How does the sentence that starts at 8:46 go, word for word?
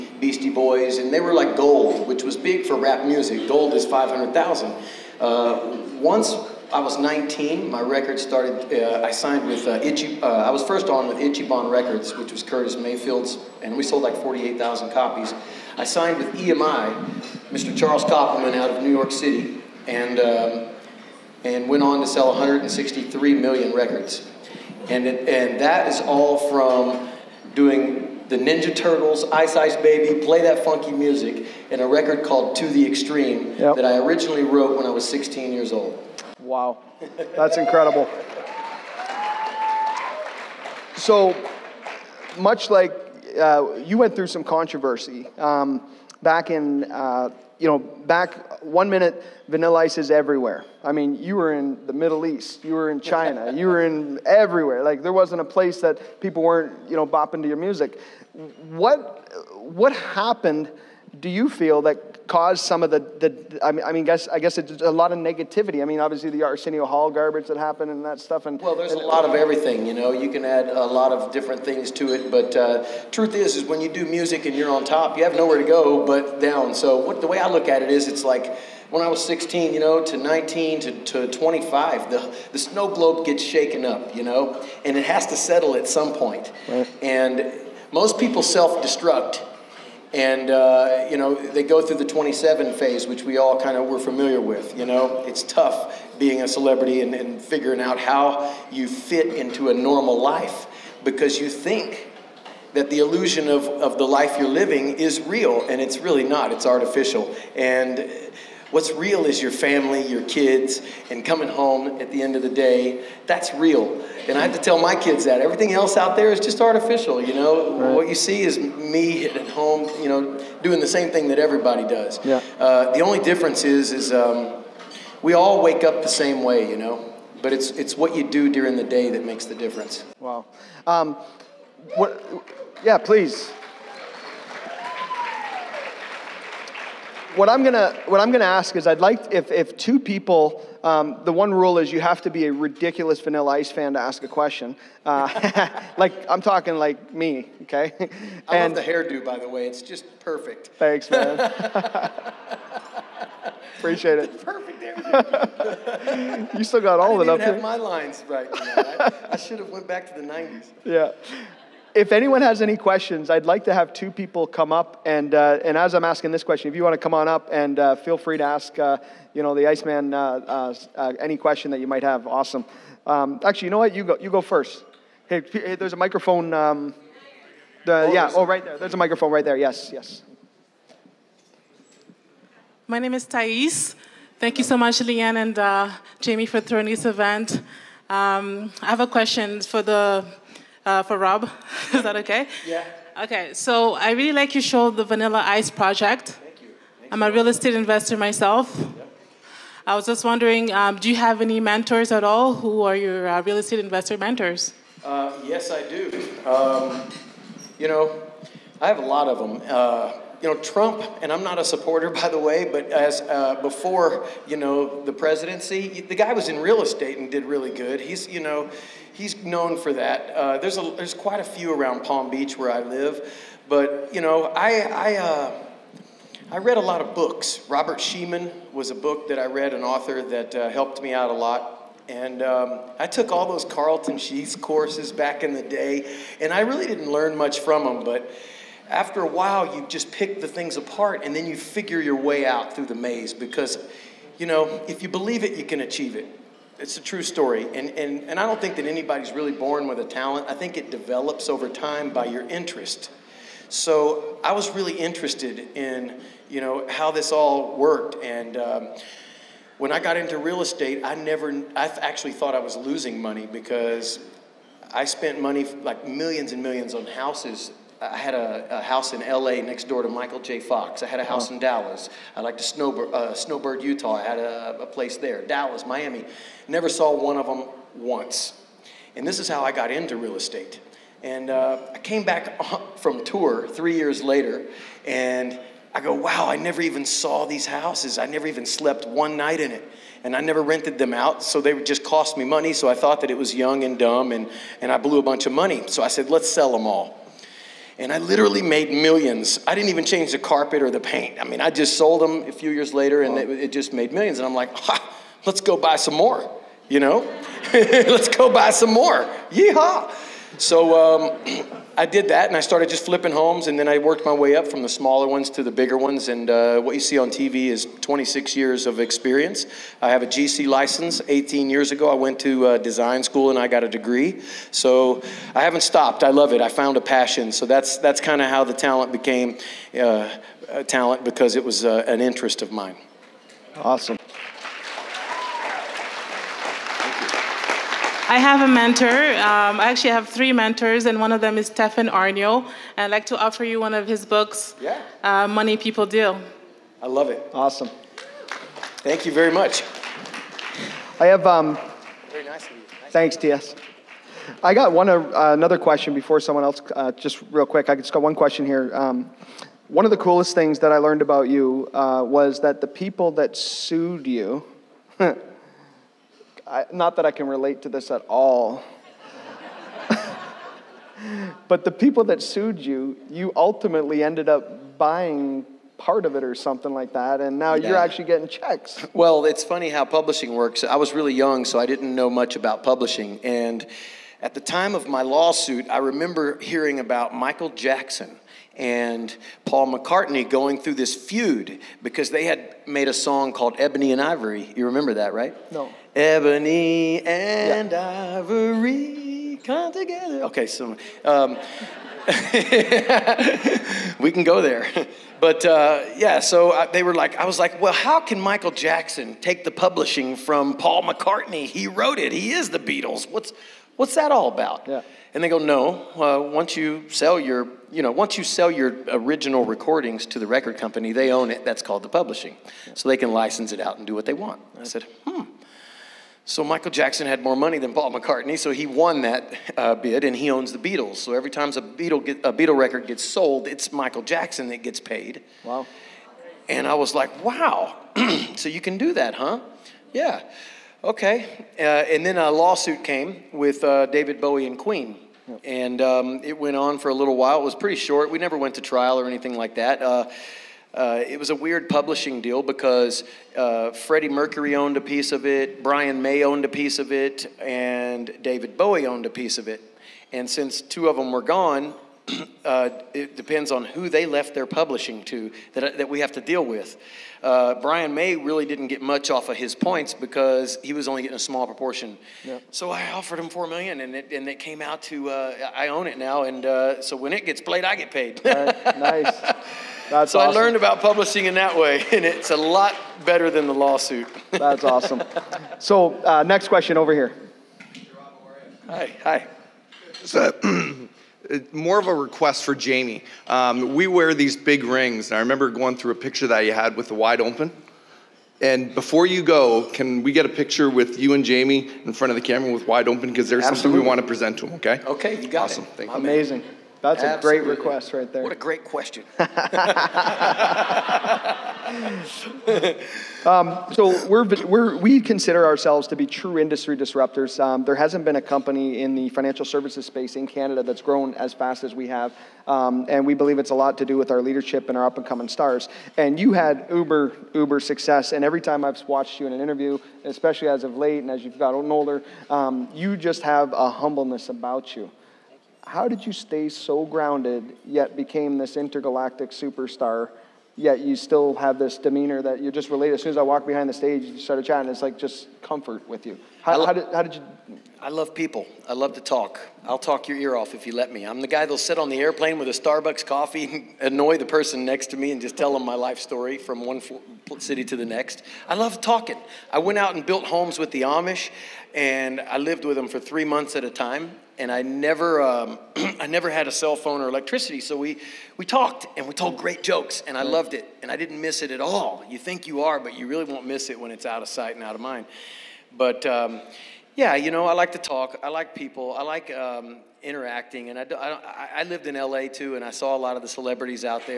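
And you had uber, uber success.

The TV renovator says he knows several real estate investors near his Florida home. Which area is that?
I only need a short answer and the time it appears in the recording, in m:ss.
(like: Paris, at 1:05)
Palm Beach, at 3:42.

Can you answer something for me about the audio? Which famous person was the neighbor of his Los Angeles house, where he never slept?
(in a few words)
Michael J. Fox.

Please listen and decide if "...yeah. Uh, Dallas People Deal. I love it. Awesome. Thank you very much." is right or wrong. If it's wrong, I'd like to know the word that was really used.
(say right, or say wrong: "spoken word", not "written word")
wrong: "Money", not "Dallas".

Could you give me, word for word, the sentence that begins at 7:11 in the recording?
So every time a Beatle, get, a Beatle record gets sold, it's Michael Jackson that gets paid.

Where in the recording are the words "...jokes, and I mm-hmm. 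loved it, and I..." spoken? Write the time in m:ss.
9:29.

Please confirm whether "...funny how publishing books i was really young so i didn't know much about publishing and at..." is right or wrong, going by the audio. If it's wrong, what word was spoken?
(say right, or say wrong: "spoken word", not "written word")
wrong: "works", not "books".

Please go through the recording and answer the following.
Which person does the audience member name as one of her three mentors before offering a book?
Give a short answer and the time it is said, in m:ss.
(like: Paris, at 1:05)
Stefan Aarnio, at 5:41.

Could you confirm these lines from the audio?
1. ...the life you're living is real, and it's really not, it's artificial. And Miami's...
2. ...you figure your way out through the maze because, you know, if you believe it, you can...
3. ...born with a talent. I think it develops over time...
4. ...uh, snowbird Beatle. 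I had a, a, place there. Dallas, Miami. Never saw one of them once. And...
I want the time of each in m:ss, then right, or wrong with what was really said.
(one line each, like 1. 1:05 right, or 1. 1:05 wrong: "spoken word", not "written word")
1. 1:43 wrong: "What", not "Miami"
2. 4:01 right
3. 4:09 right
4. 4:33 wrong: "Utah", not "Beatle".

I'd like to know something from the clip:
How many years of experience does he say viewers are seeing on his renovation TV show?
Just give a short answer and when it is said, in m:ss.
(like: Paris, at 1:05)
26 years, at 5:18.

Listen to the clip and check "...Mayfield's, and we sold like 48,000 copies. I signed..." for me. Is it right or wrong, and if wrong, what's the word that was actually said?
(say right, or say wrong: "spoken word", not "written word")
right.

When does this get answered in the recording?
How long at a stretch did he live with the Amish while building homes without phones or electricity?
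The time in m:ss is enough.
9:23.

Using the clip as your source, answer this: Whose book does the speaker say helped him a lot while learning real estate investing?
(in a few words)
Robert Shemin.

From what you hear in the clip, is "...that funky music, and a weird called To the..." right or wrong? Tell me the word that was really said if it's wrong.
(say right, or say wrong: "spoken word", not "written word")
wrong: "record", not "weird".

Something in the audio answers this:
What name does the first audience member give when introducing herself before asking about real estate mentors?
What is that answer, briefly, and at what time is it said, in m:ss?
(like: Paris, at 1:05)
Thais, at 3:03.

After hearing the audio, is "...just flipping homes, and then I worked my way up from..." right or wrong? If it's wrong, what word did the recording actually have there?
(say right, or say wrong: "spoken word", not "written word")
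right.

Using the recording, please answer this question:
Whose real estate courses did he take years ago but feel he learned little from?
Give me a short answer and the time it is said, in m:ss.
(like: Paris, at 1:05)
Carlton Sheets, at 3:53.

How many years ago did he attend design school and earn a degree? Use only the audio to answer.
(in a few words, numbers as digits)
18 years.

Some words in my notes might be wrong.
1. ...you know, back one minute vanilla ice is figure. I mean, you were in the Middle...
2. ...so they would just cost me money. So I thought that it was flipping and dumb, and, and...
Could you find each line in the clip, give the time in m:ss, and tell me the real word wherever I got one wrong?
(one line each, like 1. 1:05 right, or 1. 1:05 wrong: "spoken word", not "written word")
1. 0:47 wrong: "everywhere", not "figure"
2. 4:51 wrong: "young", not "flipping".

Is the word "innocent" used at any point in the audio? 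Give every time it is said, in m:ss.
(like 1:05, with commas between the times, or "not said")
not said.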